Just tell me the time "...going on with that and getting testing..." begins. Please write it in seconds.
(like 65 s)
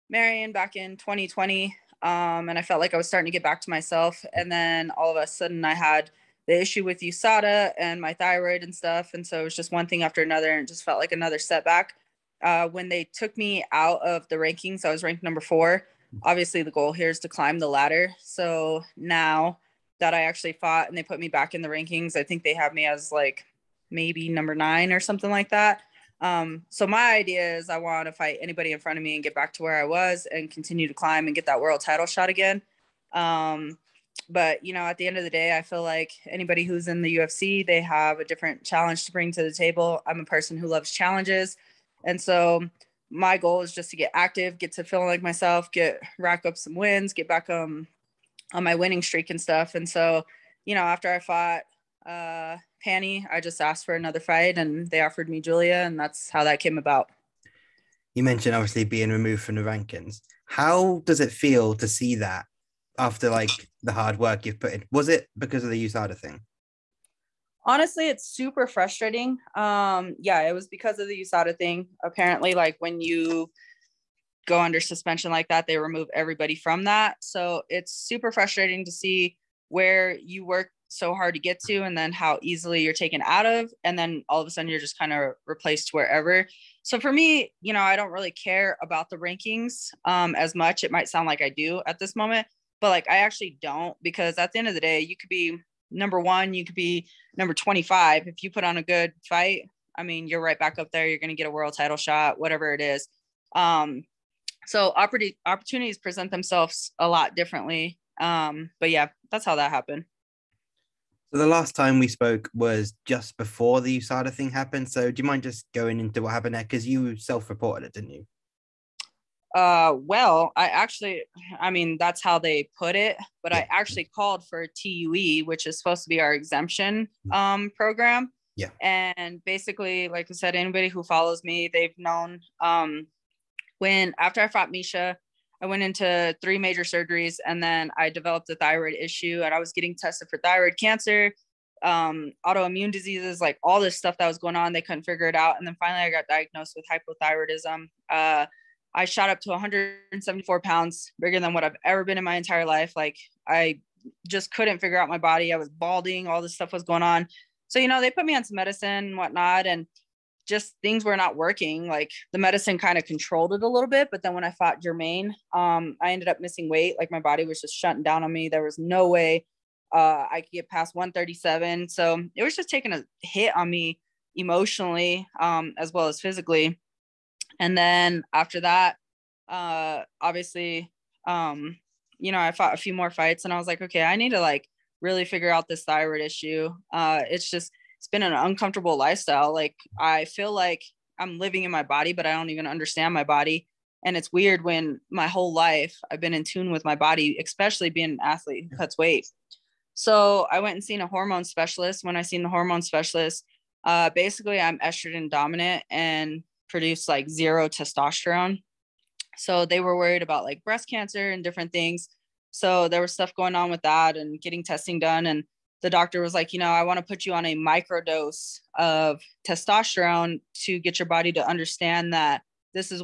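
213 s.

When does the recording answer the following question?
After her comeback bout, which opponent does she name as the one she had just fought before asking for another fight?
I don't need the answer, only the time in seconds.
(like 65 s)
52 s.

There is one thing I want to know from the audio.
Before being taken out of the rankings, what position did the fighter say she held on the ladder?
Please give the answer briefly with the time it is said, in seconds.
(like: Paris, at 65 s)
4, at 15 s.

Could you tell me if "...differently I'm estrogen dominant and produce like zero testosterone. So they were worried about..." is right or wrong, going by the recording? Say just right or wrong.
wrong.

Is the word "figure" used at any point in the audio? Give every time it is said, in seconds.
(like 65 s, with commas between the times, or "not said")
145 s, 154 s, 185 s.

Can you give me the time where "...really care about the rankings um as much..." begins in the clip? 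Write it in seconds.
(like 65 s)
88 s.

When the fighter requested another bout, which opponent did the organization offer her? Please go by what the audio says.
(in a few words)
Julia.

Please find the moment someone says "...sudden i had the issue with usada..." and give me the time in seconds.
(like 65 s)
5 s.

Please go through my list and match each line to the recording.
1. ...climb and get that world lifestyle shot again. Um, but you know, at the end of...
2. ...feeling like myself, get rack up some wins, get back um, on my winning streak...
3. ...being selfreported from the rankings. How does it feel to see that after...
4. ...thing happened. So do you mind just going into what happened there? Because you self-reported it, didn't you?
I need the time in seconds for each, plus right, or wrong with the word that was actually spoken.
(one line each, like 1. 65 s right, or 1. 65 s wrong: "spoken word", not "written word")
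1. 30 s wrong: "title", not "lifestyle"
2. 44 s right
3. 58 s wrong: "removed", not "selfreported"
4. 114 s right.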